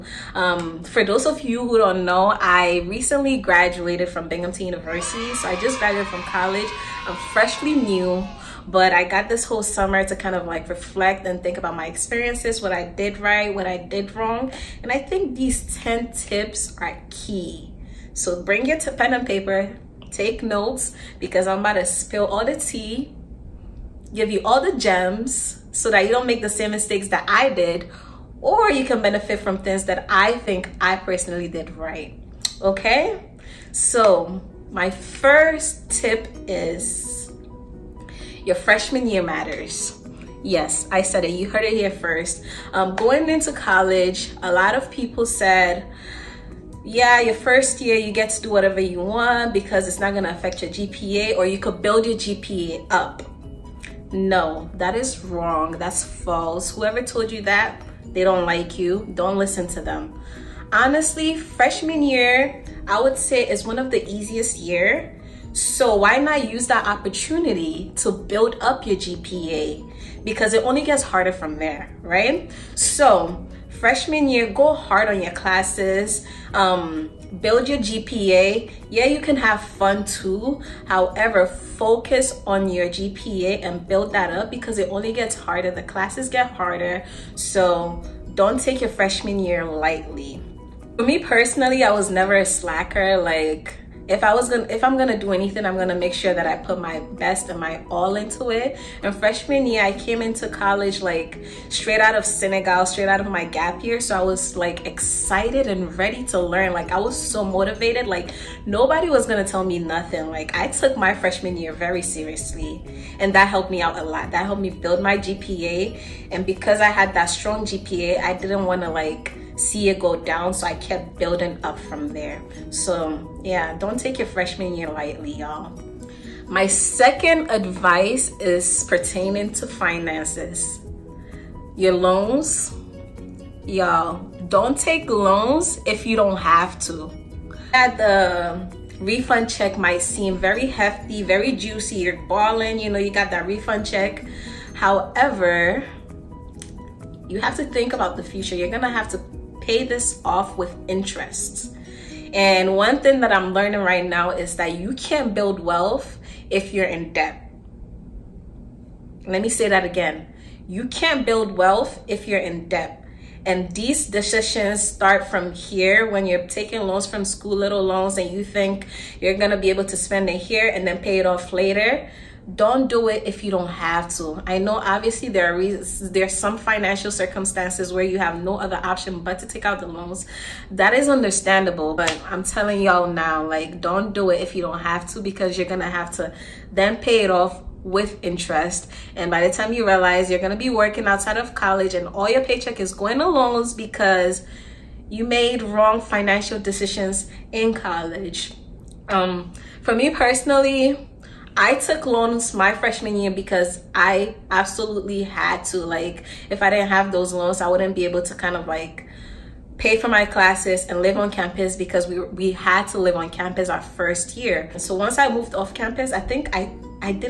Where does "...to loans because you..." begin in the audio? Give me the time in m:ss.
3:13.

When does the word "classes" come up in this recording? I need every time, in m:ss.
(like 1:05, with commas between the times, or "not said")
1:15, 1:25, 3:30.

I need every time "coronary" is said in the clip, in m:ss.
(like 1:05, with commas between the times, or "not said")
not said.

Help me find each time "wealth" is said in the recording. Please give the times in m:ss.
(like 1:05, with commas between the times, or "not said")
2:35, 2:41.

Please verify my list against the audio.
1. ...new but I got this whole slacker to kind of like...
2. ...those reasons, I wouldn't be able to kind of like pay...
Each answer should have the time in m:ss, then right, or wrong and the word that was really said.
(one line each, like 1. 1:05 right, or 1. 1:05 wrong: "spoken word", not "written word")
1. 0:07 wrong: "summer", not "slacker"
2. 3:27 wrong: "loans", not "reasons".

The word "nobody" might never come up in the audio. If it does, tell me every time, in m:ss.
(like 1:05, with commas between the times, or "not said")
1:48.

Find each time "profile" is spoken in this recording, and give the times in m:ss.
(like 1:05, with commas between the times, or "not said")
not said.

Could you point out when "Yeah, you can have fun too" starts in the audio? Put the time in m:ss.
1:18.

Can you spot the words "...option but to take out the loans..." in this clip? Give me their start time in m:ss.
2:58.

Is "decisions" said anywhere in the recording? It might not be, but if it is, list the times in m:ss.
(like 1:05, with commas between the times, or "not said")
2:44, 3:16.